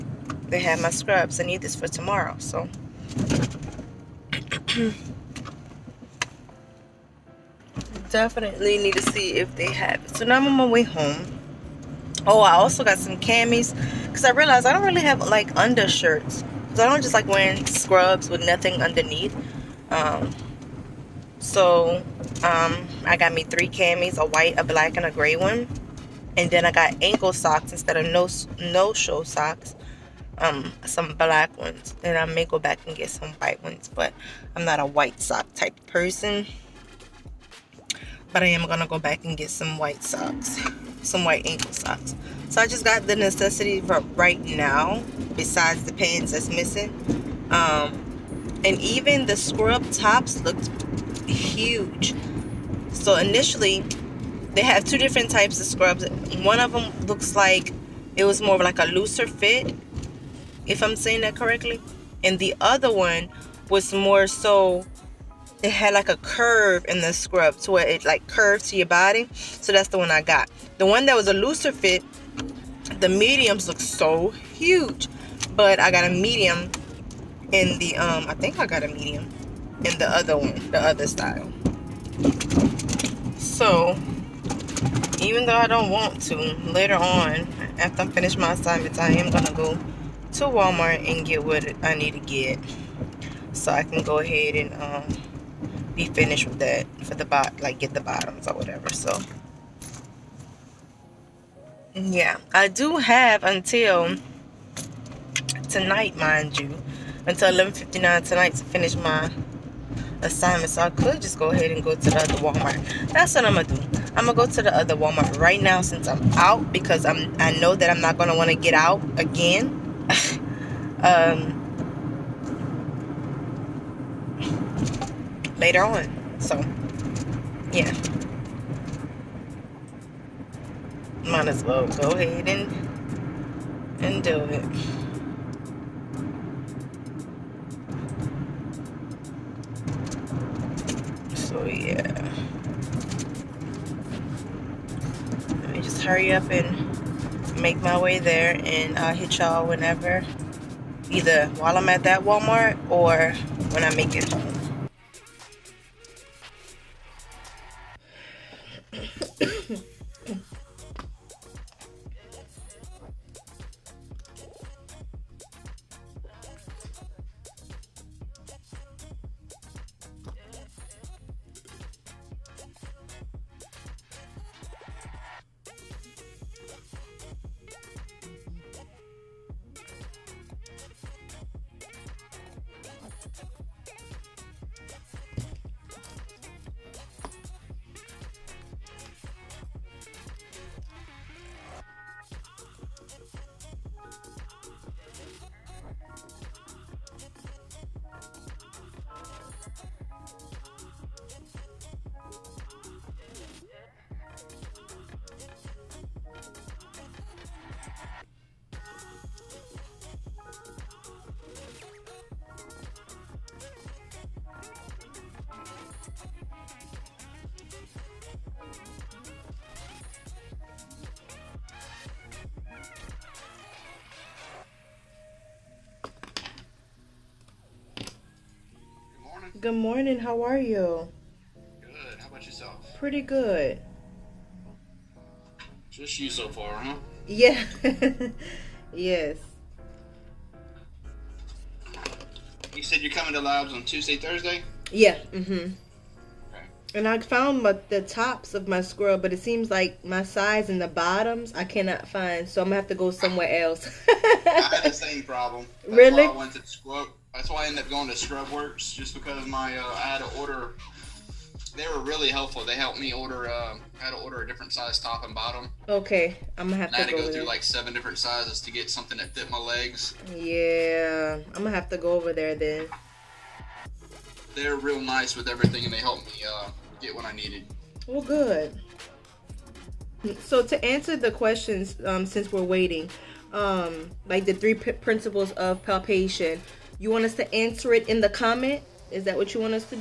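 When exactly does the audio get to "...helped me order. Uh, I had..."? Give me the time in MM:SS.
04:22.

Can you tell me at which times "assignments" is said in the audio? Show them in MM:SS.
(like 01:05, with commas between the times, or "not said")
01:28, 01:50.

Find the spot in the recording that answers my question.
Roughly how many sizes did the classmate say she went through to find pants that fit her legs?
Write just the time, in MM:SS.
04:27.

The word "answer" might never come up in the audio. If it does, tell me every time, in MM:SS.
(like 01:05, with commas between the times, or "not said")
04:40, 04:47.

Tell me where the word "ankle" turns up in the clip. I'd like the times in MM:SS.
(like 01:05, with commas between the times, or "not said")
00:27, 00:41.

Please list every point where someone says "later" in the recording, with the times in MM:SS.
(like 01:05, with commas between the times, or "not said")
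01:26, 02:05.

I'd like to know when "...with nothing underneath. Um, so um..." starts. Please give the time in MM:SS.
00:18.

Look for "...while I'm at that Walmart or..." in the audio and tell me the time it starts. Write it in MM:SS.
02:31.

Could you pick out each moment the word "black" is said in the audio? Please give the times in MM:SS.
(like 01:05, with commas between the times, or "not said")
00:24, 00:31.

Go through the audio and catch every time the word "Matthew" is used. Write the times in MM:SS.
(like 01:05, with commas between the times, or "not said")
not said.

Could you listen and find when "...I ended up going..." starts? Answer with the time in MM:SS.
04:17.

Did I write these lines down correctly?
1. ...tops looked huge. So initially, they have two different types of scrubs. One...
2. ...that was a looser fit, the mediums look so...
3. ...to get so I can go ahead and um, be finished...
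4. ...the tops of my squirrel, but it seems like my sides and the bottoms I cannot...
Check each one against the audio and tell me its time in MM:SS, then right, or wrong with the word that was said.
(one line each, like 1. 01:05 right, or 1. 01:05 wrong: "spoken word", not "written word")
1. 00:49 right
2. 01:11 right
3. 01:32 right
4. 04:07 right.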